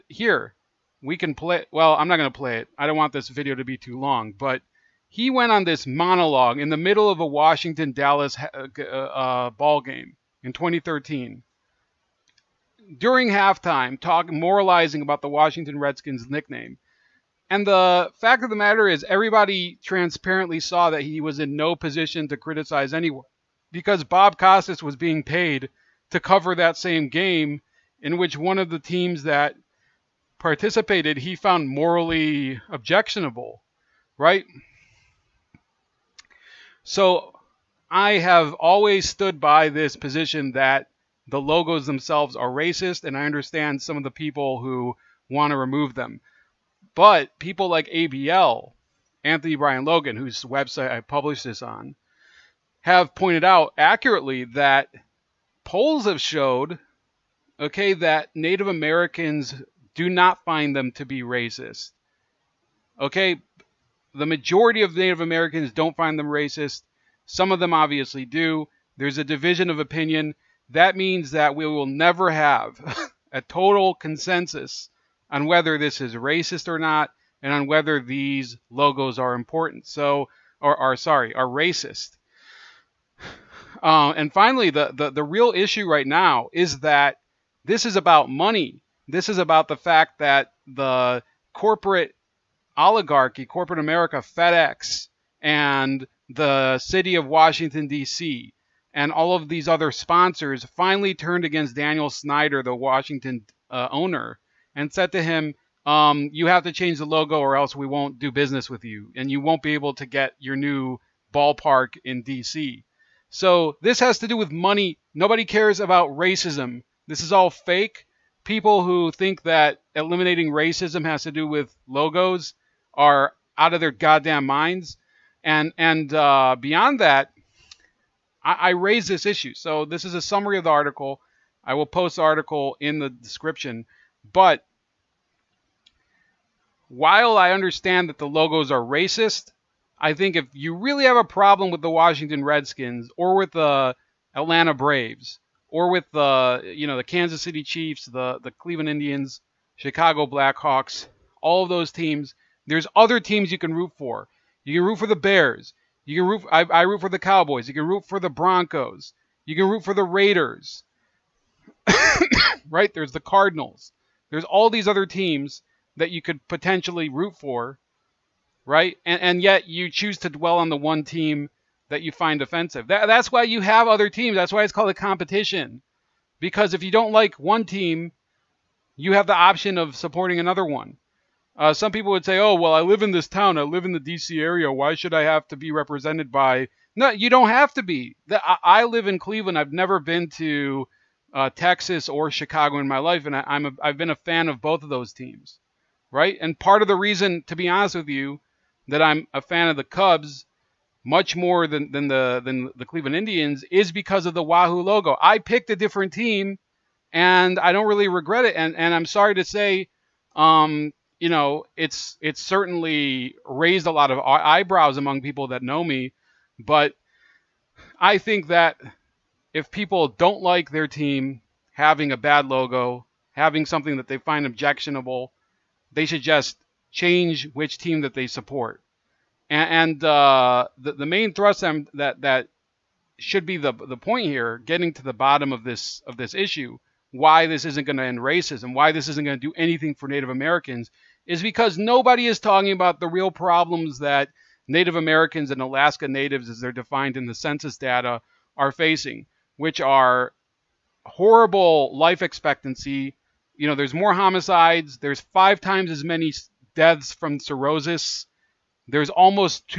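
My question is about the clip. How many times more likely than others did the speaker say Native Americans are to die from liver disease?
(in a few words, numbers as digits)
5.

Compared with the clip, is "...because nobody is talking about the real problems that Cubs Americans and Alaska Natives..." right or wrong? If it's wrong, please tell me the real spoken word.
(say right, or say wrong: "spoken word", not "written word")
wrong: "Native", not "Cubs".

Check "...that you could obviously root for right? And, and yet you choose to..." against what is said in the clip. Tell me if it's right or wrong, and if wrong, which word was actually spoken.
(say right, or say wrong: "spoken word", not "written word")
wrong: "potentially", not "obviously".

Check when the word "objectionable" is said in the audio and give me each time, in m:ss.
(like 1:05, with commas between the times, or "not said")
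0:32, 3:44.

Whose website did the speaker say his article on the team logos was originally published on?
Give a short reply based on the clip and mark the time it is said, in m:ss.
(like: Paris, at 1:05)
Anthony Brian Logan, at 0:49.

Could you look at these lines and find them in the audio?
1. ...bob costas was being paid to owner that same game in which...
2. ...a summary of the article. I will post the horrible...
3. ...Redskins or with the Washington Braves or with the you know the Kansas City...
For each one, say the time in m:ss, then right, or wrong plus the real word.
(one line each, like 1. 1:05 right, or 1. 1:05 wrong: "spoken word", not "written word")
1. 0:24 wrong: "cover", not "owner"
2. 2:10 wrong: "article", not "horrible"
3. 2:22 wrong: "Atlanta", not "Washington".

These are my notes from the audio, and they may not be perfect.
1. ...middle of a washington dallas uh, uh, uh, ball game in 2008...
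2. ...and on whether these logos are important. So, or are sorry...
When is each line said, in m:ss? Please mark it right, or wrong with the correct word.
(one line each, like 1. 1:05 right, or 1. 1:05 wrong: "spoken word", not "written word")
1. 0:06 wrong: "2013", not "2008"
2. 1:17 right.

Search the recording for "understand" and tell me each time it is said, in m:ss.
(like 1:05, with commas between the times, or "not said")
0:43, 2:17.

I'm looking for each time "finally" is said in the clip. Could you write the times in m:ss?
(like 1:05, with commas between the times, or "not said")
1:24, 1:40.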